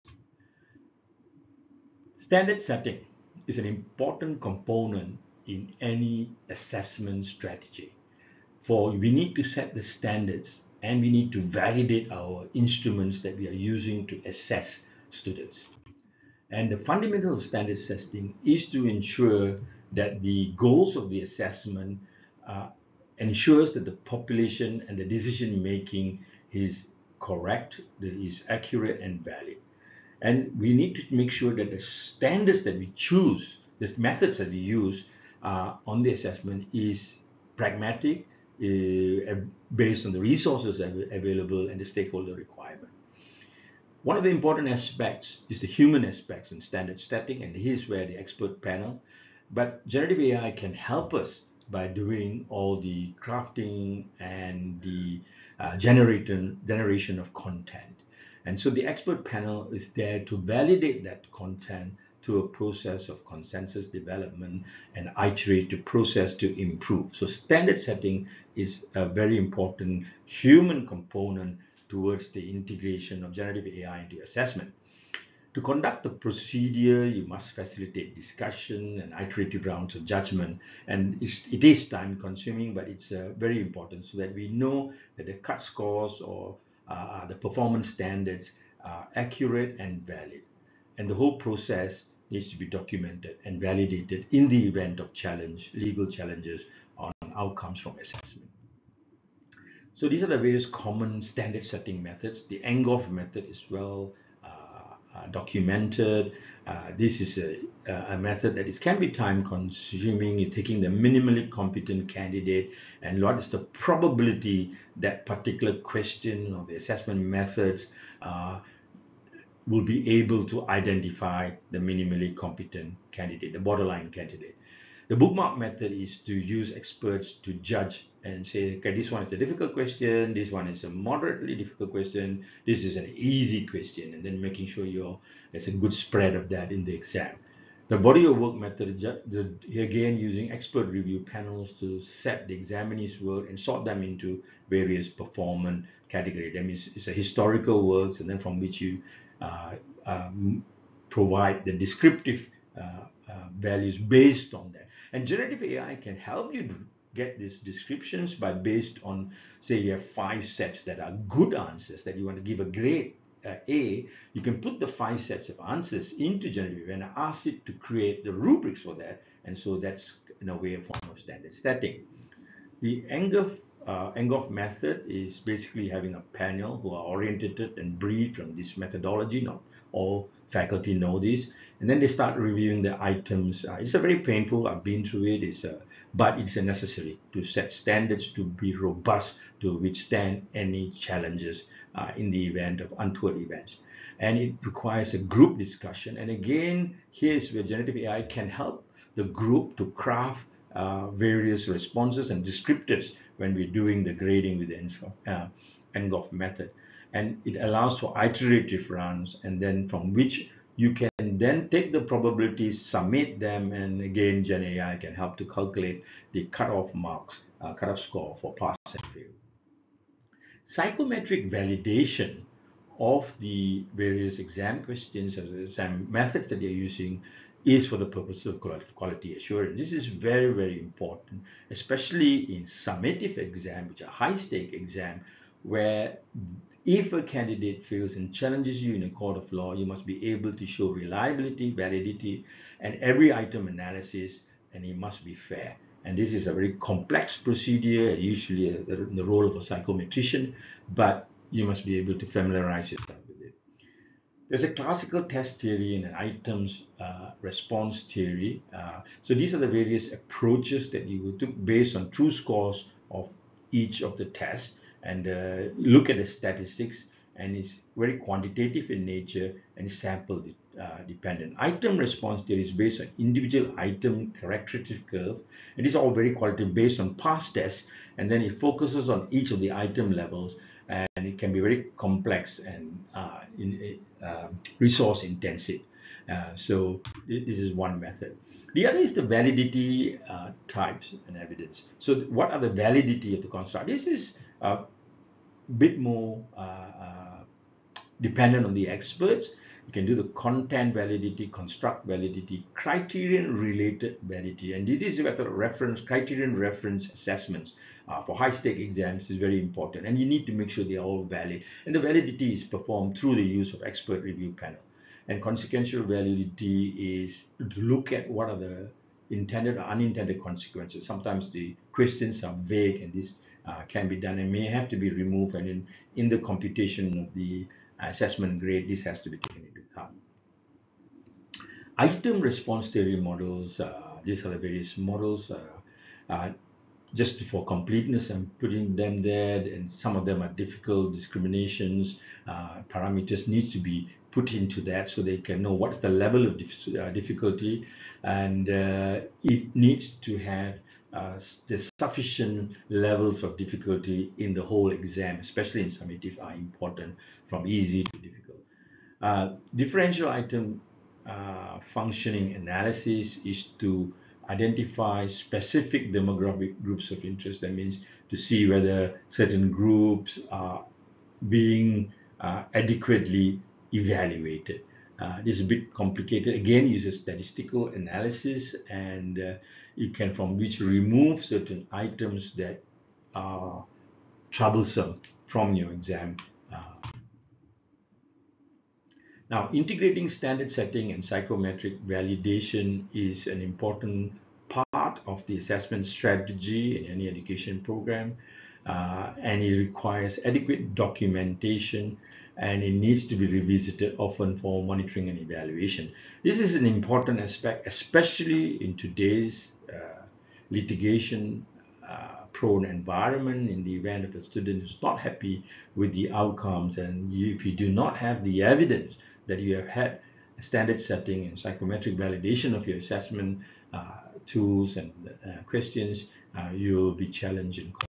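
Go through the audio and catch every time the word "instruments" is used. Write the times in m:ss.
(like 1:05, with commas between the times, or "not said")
0:12.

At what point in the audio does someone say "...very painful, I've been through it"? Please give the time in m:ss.
3:03.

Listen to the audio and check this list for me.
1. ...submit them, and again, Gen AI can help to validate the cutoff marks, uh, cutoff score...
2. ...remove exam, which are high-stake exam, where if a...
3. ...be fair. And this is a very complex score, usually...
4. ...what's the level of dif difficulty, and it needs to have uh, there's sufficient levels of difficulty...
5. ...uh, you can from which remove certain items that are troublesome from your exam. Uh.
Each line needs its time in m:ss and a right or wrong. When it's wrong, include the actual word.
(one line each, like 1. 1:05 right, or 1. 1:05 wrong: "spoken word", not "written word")
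1. 3:32 wrong: "calculate", not "validate"
2. 3:52 wrong: "summative", not "remove"
3. 4:05 wrong: "procedure", not "score"
4. 5:45 right
5. 6:19 right.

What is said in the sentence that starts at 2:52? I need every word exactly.
The Angoff, uh, method is basically having a panel who are oriented and briefed from this methodology.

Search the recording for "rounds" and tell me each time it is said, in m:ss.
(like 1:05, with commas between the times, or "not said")
1:19, 3:28.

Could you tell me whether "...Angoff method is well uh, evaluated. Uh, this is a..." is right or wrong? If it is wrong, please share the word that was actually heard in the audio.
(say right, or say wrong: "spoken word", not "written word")
wrong: "documented", not "evaluated".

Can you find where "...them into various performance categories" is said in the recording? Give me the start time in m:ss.
2:23.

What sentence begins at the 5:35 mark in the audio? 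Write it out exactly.
Uh, uh just for completeness, I'm putting them there, and some of them are difficult discriminations.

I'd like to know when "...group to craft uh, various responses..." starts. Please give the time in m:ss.
3:19.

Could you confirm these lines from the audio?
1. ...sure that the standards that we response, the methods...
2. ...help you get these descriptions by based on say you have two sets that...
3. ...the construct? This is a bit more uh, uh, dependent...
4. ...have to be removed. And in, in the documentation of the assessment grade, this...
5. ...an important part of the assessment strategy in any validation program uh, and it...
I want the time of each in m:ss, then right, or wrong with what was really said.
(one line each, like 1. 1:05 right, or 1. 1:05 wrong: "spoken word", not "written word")
1. 0:31 wrong: "choose", not "response"
2. 2:36 wrong: "five", not "two"
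3. 4:53 right
4. 5:24 wrong: "computation", not "documentation"
5. 6:33 wrong: "education", not "validation".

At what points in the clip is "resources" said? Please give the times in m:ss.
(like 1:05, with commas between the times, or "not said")
0:40, 4:44.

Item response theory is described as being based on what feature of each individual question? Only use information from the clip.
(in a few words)
item characteristic curve.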